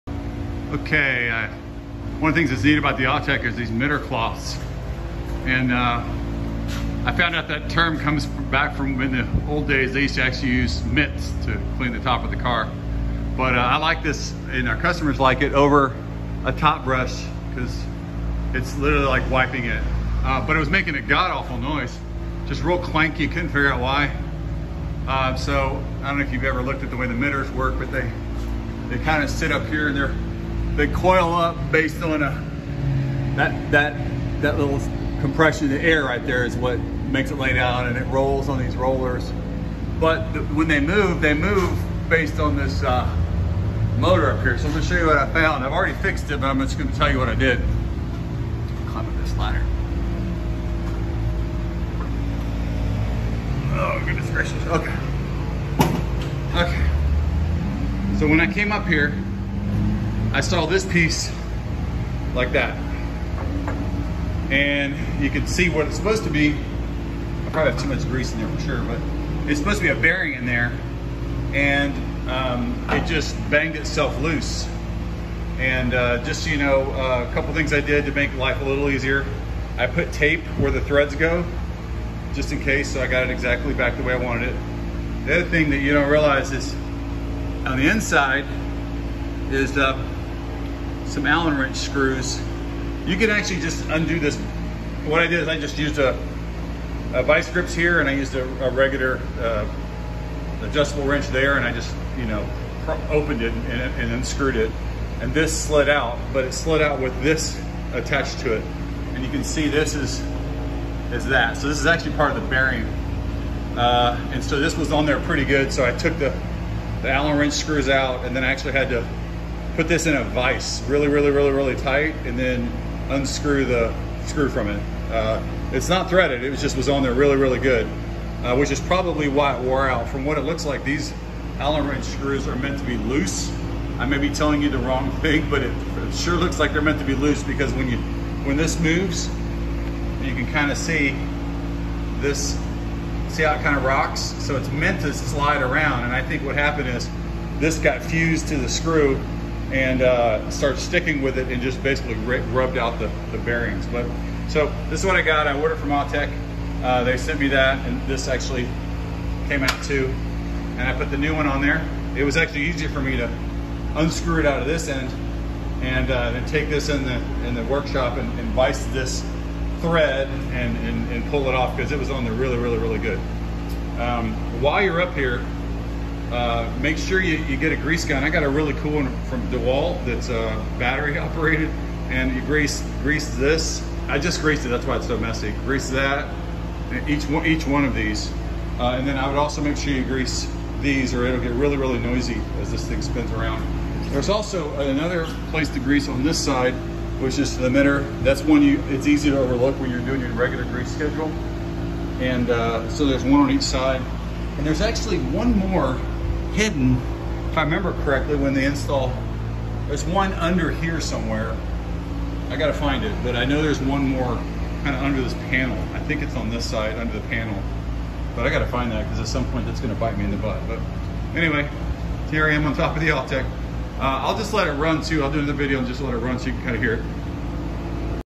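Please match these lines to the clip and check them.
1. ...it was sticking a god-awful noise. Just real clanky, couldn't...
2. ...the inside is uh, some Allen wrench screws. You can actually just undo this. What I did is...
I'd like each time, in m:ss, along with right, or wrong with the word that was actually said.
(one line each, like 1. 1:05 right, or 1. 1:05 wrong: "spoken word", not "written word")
1. 0:20 wrong: "making", not "sticking"
2. 1:27 right.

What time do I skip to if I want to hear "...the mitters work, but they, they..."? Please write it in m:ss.
0:27.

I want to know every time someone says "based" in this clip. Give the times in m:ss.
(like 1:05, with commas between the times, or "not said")
0:31, 0:42.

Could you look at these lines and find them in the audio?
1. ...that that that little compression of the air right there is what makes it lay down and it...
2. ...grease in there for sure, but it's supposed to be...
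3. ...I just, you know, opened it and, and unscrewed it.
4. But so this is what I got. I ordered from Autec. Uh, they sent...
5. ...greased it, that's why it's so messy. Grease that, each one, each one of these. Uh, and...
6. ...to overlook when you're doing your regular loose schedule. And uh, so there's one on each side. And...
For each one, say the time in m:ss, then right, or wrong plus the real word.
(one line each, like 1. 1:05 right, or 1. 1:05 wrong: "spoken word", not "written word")
1. 0:33 right
2. 1:08 right
3. 1:41 right
4. 2:33 right
5. 3:04 right
6. 3:19 wrong: "grease", not "loose".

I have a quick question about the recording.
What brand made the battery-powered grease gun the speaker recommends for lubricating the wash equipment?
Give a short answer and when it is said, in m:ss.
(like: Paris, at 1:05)
DeWalt, at 2:59.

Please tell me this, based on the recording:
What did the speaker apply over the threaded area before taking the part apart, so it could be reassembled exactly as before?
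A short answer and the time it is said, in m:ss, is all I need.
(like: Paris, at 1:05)
tape, at 1:20.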